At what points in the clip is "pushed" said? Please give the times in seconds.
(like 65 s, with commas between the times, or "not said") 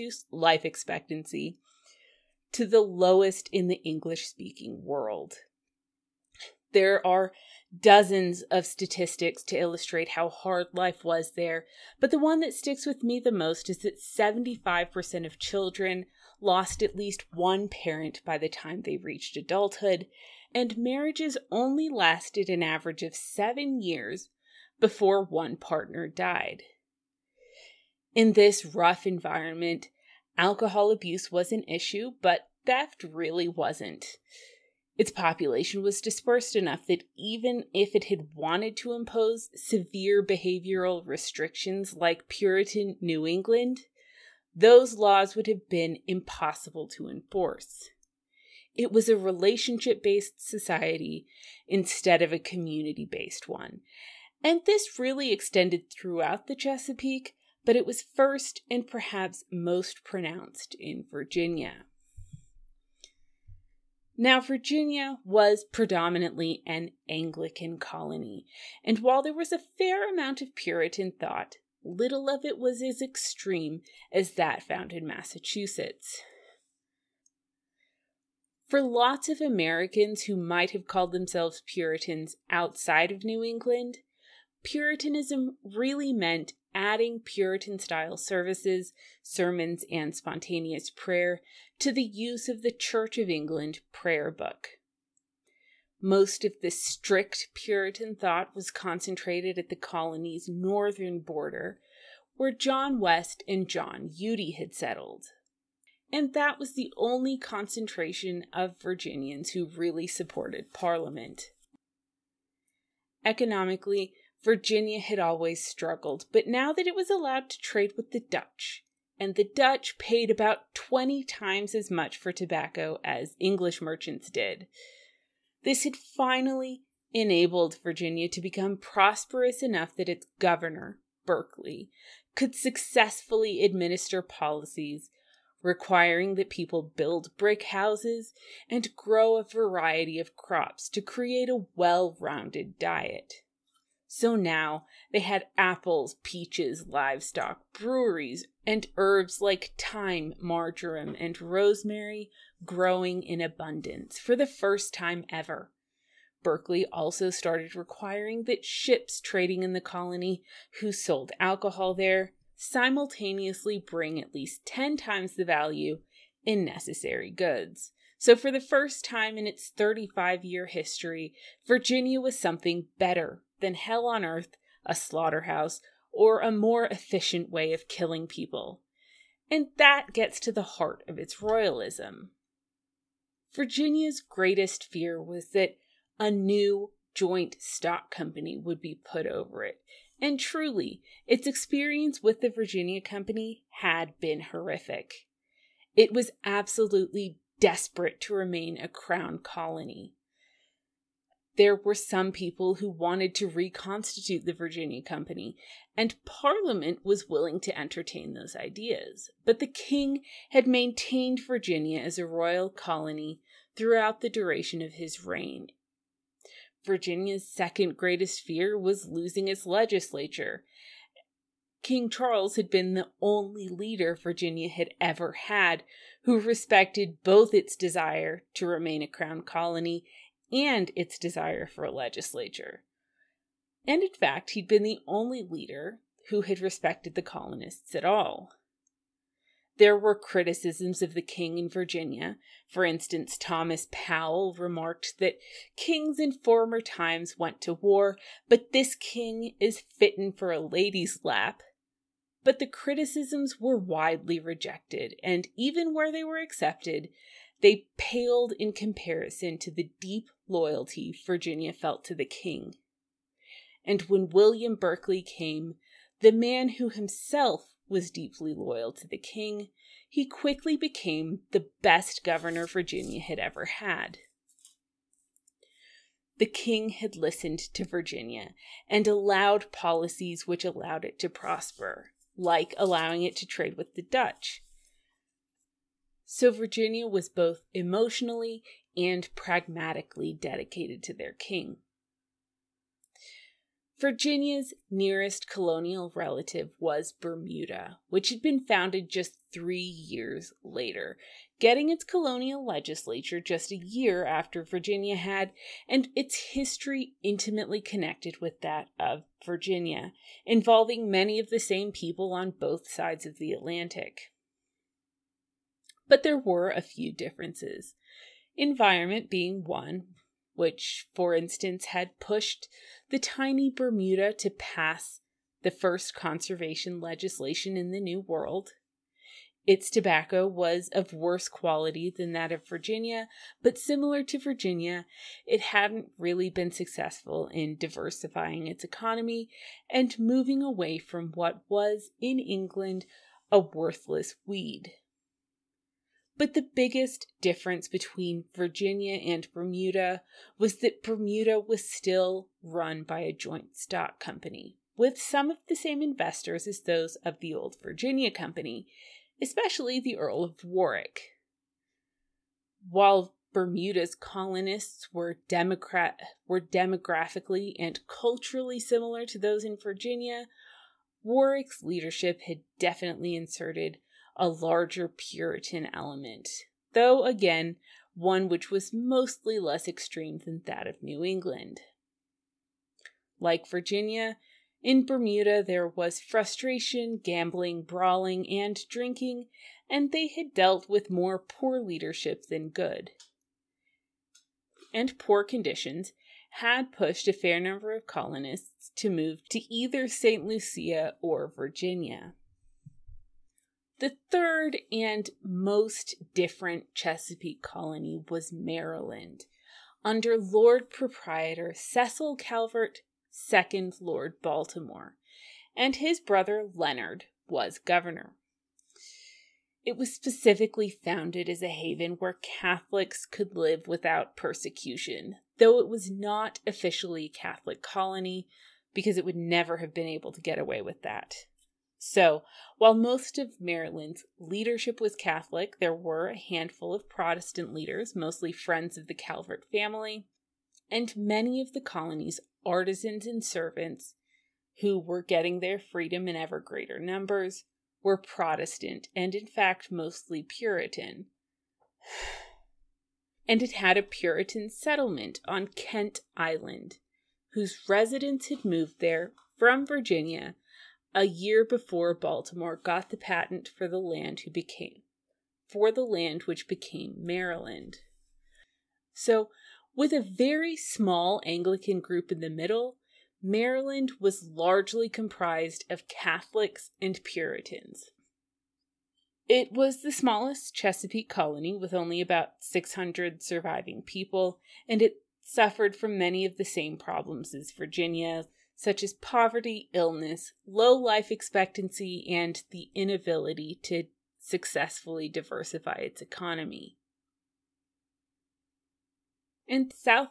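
322 s, 396 s.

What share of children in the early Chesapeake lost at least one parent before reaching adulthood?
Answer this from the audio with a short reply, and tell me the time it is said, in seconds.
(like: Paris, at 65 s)
75%, at 14 s.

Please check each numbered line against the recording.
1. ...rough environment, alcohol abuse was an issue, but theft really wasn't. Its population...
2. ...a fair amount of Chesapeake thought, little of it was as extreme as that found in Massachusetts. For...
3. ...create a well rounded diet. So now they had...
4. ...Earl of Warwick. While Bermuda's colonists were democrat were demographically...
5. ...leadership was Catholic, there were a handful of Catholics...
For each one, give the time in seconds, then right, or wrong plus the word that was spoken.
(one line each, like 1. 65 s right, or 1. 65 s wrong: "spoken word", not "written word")
1. 28 s right
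2. 69 s wrong: "Puritan", not "Chesapeake"
3. 141 s right
4. 360 s right
5. 434 s wrong: "Protestant", not "Catholics".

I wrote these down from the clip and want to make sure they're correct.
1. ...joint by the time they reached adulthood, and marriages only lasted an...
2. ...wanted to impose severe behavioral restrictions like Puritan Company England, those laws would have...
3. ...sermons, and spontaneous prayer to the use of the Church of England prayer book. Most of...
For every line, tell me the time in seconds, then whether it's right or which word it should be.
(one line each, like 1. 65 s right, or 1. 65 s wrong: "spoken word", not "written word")
1. 17 s wrong: "parent", not "joint"
2. 38 s wrong: "New", not "Company"
3. 89 s right.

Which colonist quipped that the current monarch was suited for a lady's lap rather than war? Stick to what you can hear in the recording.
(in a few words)
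Thomas Powell.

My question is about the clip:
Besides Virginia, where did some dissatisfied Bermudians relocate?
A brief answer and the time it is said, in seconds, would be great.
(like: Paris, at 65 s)
St. Lucia, at 400 s.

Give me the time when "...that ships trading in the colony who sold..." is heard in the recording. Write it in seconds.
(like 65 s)
158 s.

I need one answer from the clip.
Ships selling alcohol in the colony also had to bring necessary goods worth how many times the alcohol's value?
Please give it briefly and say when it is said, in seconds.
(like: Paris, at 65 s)
10, at 164 s.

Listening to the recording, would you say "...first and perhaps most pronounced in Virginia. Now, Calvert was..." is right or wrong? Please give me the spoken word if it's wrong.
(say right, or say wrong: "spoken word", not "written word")
wrong: "Virginia", not "Calvert".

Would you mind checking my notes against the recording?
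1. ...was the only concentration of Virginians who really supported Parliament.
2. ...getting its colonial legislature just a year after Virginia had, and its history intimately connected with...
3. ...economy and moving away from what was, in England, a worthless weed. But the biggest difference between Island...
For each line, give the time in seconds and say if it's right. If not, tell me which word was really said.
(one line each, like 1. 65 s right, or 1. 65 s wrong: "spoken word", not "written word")
1. 106 s right
2. 301 s right
3. 338 s wrong: "Virginia", not "Island".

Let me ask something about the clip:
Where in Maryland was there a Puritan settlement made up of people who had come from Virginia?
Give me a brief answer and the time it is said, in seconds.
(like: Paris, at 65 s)
Kent Island, at 455 s.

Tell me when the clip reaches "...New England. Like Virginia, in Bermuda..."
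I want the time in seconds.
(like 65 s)
381 s.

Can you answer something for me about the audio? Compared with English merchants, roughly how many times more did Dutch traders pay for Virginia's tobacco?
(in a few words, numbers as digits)
20.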